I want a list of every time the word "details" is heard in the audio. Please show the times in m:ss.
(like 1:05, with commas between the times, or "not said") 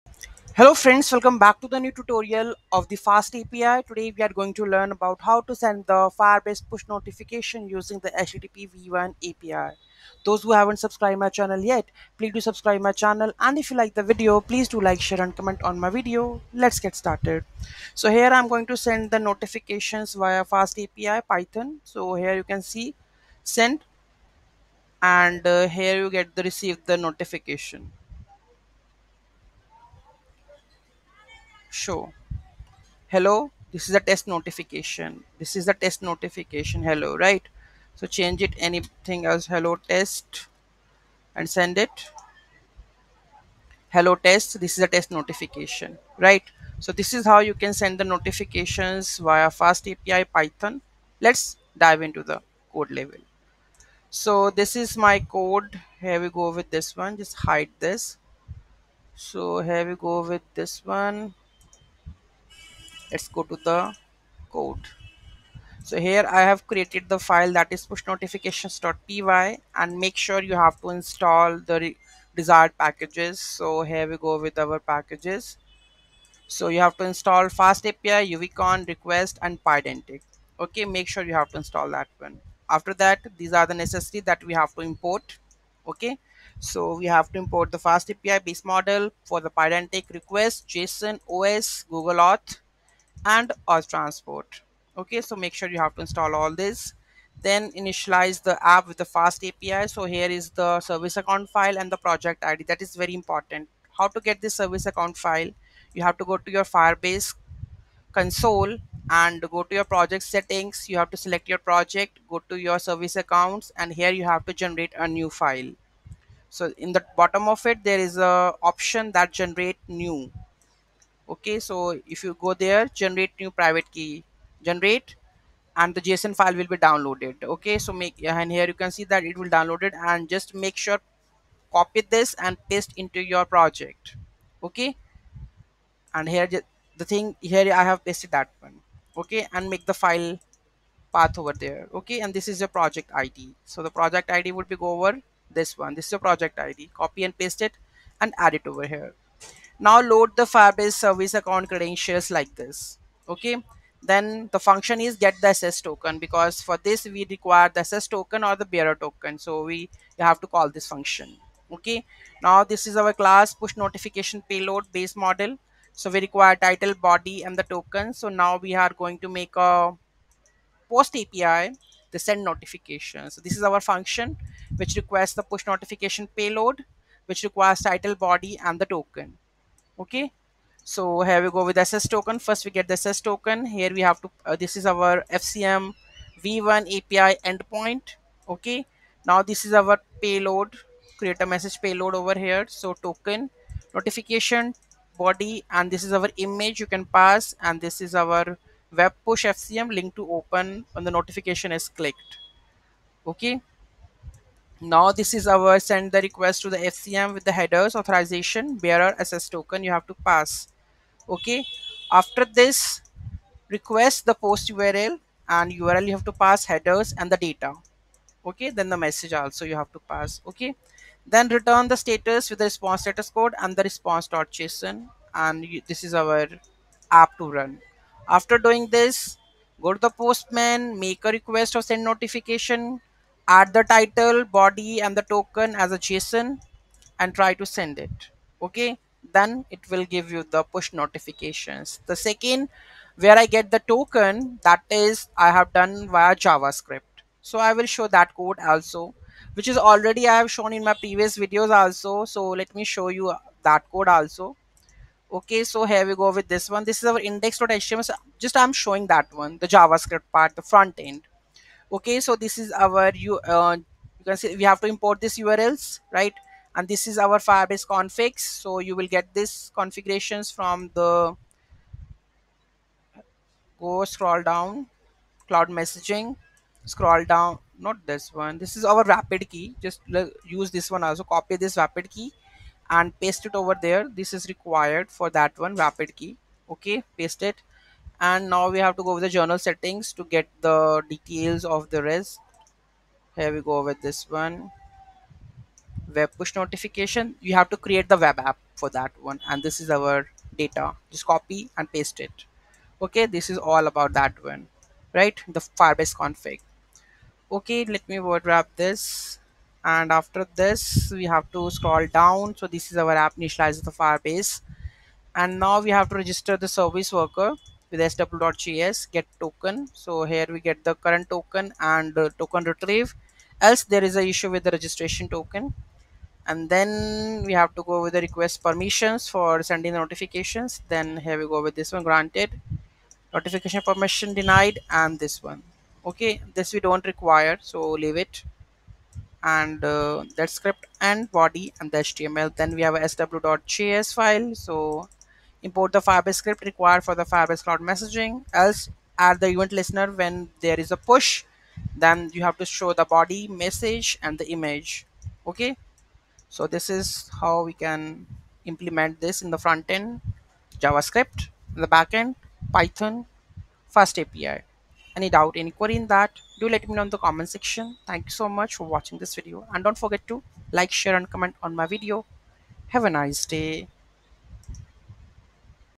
4:51.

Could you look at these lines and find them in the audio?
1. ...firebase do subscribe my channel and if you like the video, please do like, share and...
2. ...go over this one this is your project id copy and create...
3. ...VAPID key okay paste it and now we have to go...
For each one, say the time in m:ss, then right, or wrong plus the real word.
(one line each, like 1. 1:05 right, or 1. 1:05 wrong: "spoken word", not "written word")
1. 0:12 wrong: "please", not "firebase"
2. 2:24 wrong: "paste", not "create"
3. 4:45 right.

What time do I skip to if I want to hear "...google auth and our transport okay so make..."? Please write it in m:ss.
1:31.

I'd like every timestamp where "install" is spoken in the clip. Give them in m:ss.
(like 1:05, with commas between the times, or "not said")
1:10, 1:17, 1:21, 1:36.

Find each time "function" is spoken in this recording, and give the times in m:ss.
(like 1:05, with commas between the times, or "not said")
2:34, 2:40, 2:53.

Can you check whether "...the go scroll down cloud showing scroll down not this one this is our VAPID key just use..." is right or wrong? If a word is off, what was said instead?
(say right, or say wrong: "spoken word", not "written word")
wrong: "messaging", not "showing".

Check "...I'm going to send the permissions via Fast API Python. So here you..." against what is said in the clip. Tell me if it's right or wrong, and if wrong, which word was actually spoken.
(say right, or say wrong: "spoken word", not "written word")
wrong: "notifications", not "permissions".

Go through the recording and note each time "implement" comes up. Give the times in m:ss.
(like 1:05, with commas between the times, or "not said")
5:58.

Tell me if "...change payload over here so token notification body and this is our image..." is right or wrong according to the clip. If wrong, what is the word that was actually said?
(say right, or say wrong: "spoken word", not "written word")
wrong: "message", not "change".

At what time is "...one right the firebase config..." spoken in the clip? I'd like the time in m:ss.
5:04.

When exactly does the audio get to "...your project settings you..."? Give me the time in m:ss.
1:49.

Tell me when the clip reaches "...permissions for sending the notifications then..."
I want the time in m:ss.
5:28.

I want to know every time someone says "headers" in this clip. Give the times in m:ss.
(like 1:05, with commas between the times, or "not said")
3:27, 3:36.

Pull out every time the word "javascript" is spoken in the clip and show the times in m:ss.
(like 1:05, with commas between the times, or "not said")
4:06, 4:19, 6:00.